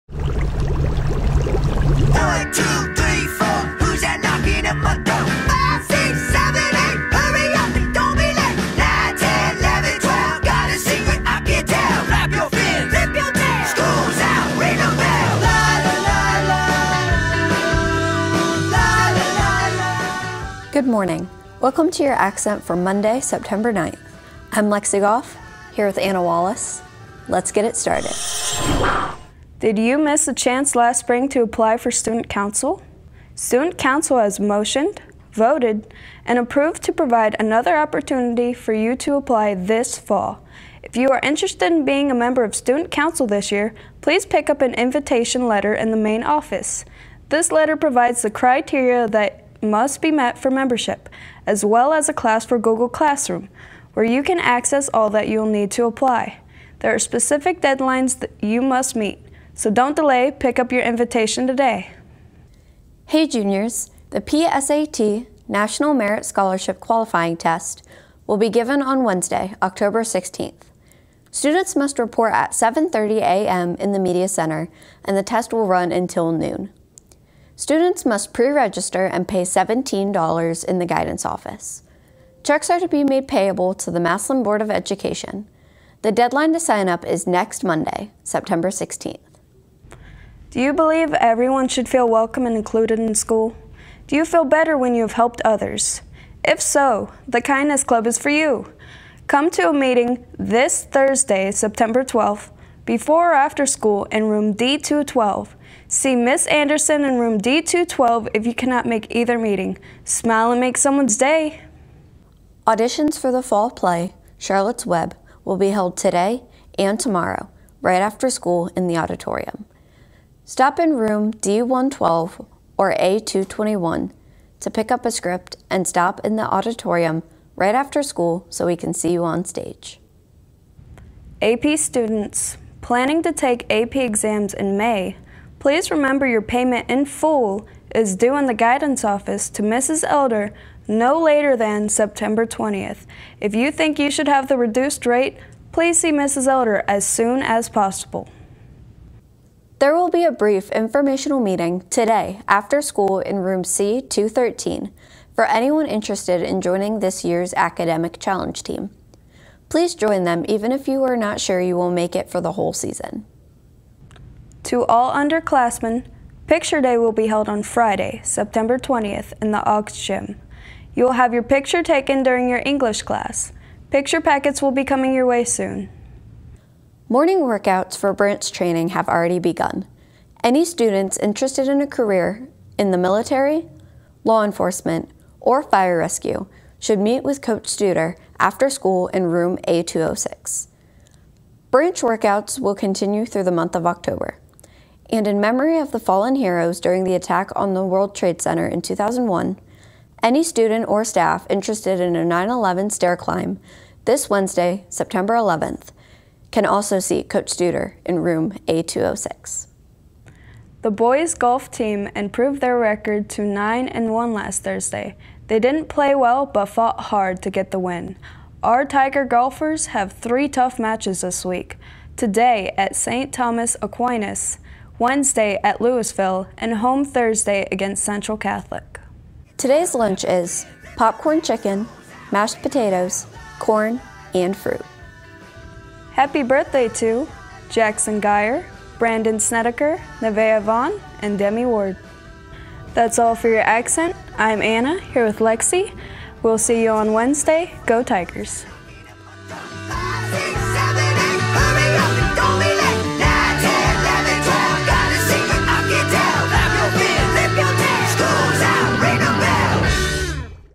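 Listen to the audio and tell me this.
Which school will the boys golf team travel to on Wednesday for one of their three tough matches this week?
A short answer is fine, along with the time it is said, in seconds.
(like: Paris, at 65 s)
Louisville, at 225 s.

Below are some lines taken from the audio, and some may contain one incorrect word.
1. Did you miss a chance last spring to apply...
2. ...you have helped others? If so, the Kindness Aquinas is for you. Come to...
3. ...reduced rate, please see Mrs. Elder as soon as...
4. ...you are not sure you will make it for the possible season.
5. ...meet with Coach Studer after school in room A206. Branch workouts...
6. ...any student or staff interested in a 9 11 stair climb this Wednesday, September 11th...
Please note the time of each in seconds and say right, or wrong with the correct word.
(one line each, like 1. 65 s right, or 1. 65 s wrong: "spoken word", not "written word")
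1. 29 s right
2. 94 s wrong: "Club", not "Aquinas"
3. 144 s right
4. 160 s wrong: "whole", not "possible"
5. 186 s right
6. 200 s right.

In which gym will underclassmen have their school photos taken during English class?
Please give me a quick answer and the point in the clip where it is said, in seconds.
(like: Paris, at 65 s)
Augs Gym, at 169 s.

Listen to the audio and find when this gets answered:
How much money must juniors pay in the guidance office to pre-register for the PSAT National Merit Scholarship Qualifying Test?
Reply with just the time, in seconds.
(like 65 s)
79 s.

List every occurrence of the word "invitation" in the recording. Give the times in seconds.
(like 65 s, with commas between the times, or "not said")
44 s, 60 s.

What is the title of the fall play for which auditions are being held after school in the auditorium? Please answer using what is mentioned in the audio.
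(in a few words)
Charlotte's Web.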